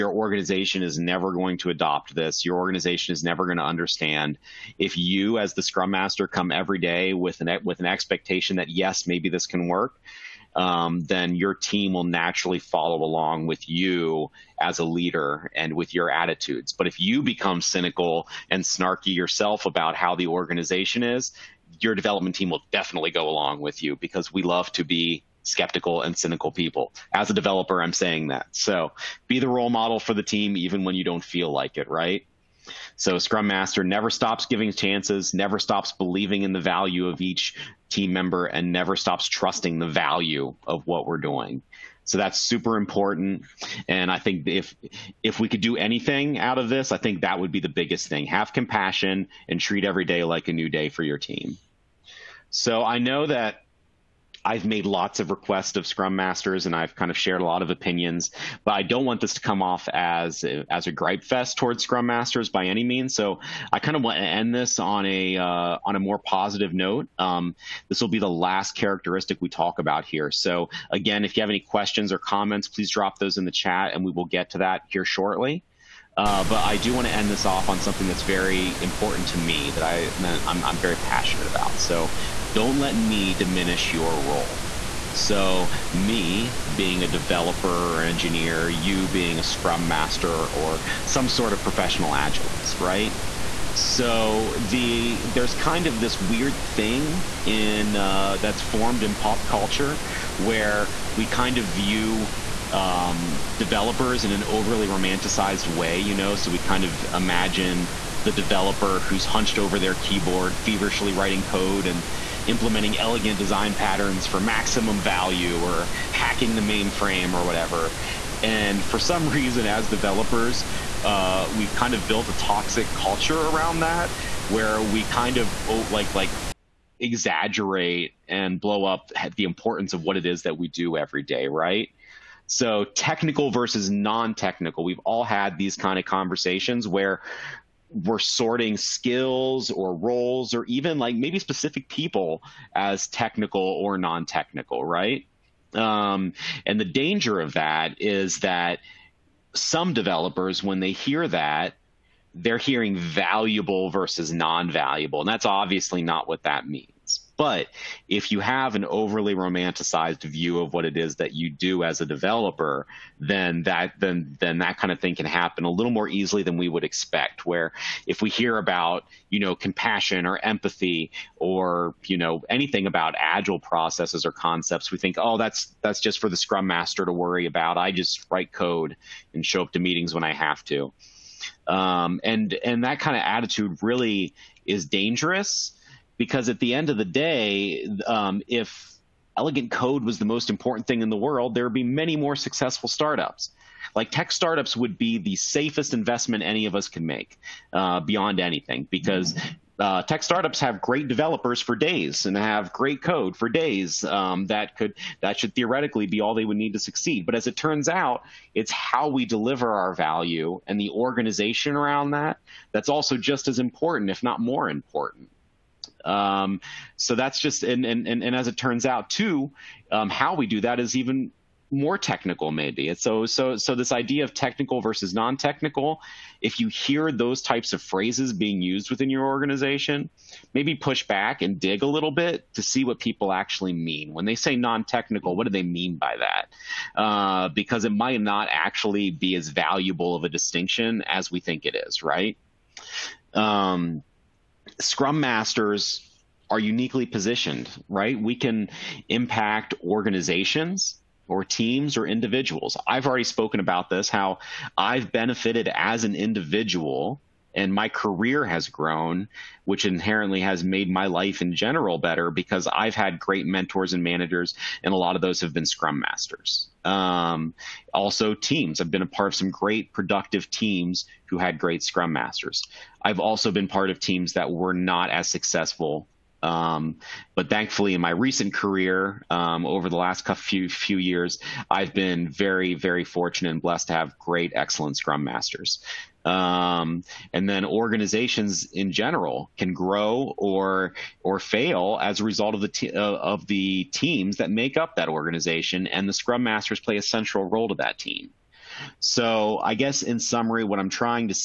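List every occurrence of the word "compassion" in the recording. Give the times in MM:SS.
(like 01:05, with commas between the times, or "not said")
00:48, 02:49.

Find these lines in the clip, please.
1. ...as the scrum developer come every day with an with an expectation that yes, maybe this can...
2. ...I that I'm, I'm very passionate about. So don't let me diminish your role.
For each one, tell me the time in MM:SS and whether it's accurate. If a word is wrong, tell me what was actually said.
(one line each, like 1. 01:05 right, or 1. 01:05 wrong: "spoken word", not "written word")
1. 00:05 wrong: "master", not "developer"
2. 01:19 right.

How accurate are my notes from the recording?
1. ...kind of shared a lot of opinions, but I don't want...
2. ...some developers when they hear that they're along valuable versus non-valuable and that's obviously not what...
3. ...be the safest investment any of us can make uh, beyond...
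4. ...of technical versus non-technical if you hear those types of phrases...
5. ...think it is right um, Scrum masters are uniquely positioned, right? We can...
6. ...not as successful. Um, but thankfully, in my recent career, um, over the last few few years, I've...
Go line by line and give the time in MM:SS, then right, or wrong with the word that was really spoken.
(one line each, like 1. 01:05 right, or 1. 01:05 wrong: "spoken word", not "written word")
1. 00:56 right
2. 02:29 wrong: "hearing", not "along"
3. 03:14 right
4. 03:44 right
5. 04:01 right
6. 04:34 right.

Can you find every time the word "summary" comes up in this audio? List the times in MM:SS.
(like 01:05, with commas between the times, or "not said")
05:00.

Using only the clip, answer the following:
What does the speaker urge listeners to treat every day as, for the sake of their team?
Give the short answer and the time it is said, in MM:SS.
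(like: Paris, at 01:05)
a new day, at 00:50.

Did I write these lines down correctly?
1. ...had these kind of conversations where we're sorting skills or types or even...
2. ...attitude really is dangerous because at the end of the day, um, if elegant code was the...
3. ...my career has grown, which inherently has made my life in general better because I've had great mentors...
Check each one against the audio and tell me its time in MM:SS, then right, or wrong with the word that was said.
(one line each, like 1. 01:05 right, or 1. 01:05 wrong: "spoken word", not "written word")
1. 02:15 wrong: "roles", not "types"
2. 03:03 right
3. 04:17 right.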